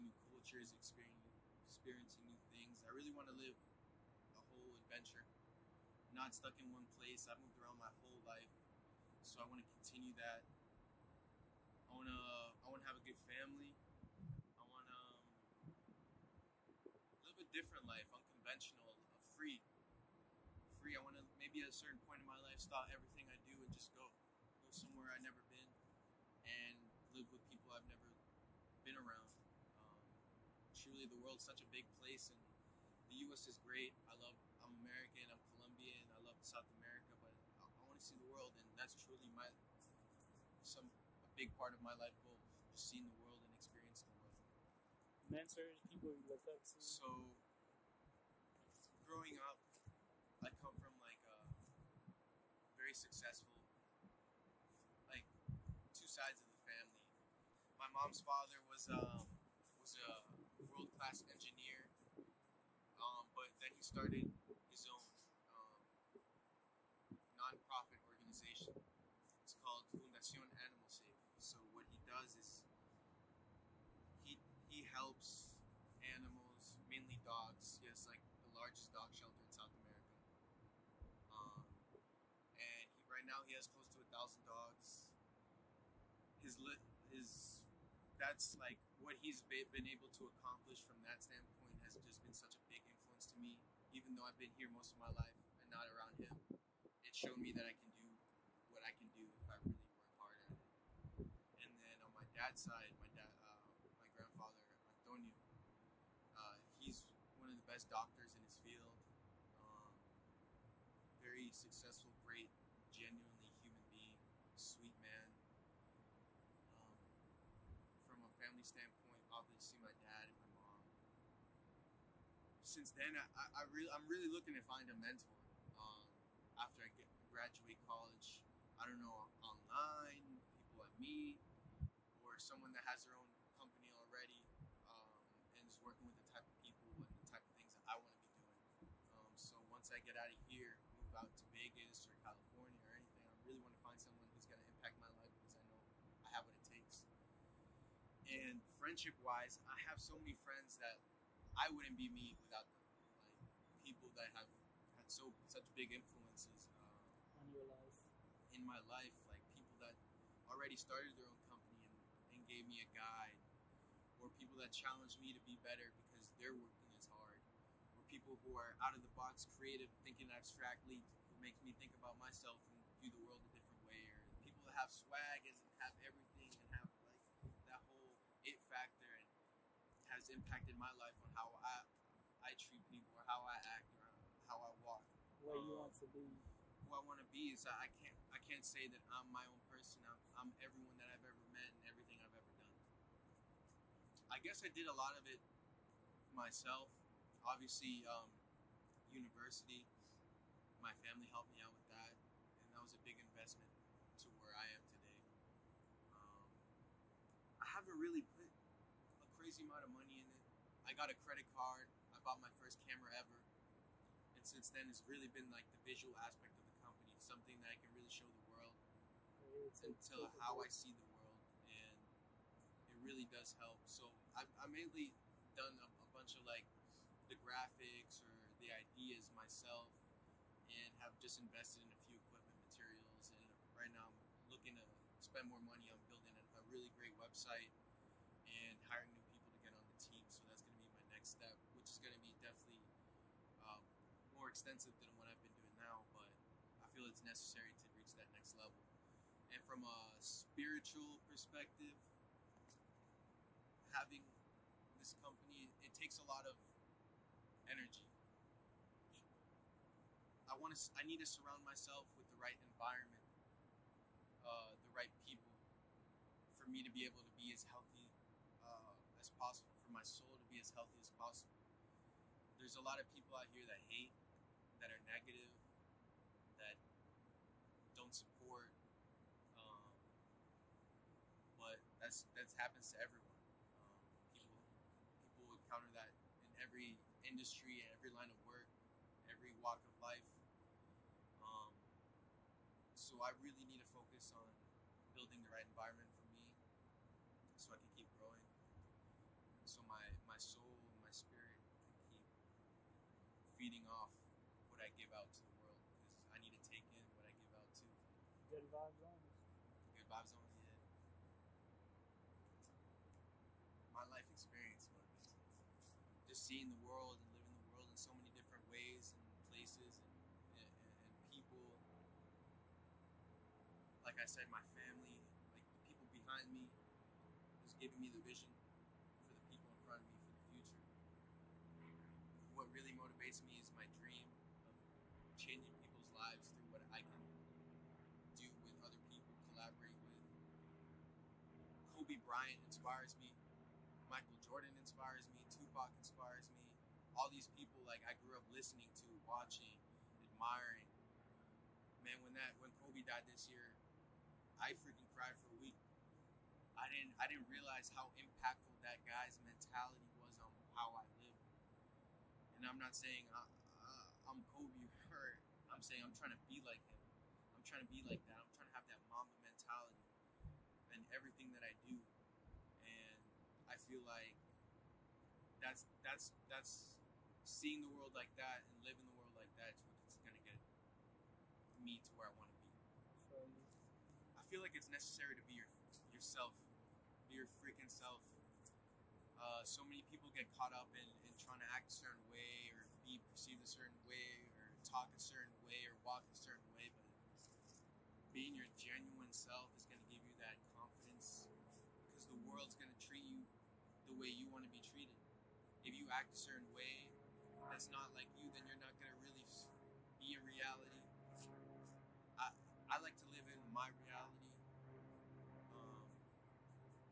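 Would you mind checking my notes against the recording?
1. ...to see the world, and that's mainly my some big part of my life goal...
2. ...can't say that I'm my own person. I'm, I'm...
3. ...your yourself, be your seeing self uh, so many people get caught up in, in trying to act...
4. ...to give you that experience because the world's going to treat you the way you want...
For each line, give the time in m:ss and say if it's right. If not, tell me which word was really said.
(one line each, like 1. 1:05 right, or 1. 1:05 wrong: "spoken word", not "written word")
1. 0:37 wrong: "truly", not "mainly"
2. 3:08 right
3. 6:25 wrong: "freaking", not "seeing"
4. 6:39 wrong: "confidence", not "experience".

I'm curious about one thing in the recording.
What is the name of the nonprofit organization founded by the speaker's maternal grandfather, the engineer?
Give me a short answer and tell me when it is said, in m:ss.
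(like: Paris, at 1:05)
Fundación Animal Save, at 1:09.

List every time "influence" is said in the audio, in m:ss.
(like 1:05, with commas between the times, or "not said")
1:32, 2:35.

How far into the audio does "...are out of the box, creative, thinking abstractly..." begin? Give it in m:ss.
2:48.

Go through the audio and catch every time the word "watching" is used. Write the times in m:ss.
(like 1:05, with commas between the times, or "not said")
5:49.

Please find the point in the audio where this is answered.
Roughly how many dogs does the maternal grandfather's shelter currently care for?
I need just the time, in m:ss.
1:24.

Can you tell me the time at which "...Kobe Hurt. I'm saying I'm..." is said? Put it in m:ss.
6:04.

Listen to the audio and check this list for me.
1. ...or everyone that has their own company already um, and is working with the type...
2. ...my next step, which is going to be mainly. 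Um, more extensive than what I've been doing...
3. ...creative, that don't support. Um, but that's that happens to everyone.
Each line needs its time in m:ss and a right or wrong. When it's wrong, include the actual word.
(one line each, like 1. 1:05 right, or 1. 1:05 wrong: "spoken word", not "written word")
1. 2:12 wrong: "someone", not "everyone"
2. 4:00 wrong: "definitely", not "mainly"
3. 4:35 wrong: "negative", not "creative".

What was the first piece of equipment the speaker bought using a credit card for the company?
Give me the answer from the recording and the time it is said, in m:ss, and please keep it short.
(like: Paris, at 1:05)
Camera, at 3:32.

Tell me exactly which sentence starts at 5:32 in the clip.
What really motivates me is my dream changing people's lives through what I can do with other people, collaborate with.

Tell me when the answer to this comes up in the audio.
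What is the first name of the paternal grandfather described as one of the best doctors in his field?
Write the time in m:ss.
1:44.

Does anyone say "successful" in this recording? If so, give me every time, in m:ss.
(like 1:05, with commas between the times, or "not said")
0:52, 1:51.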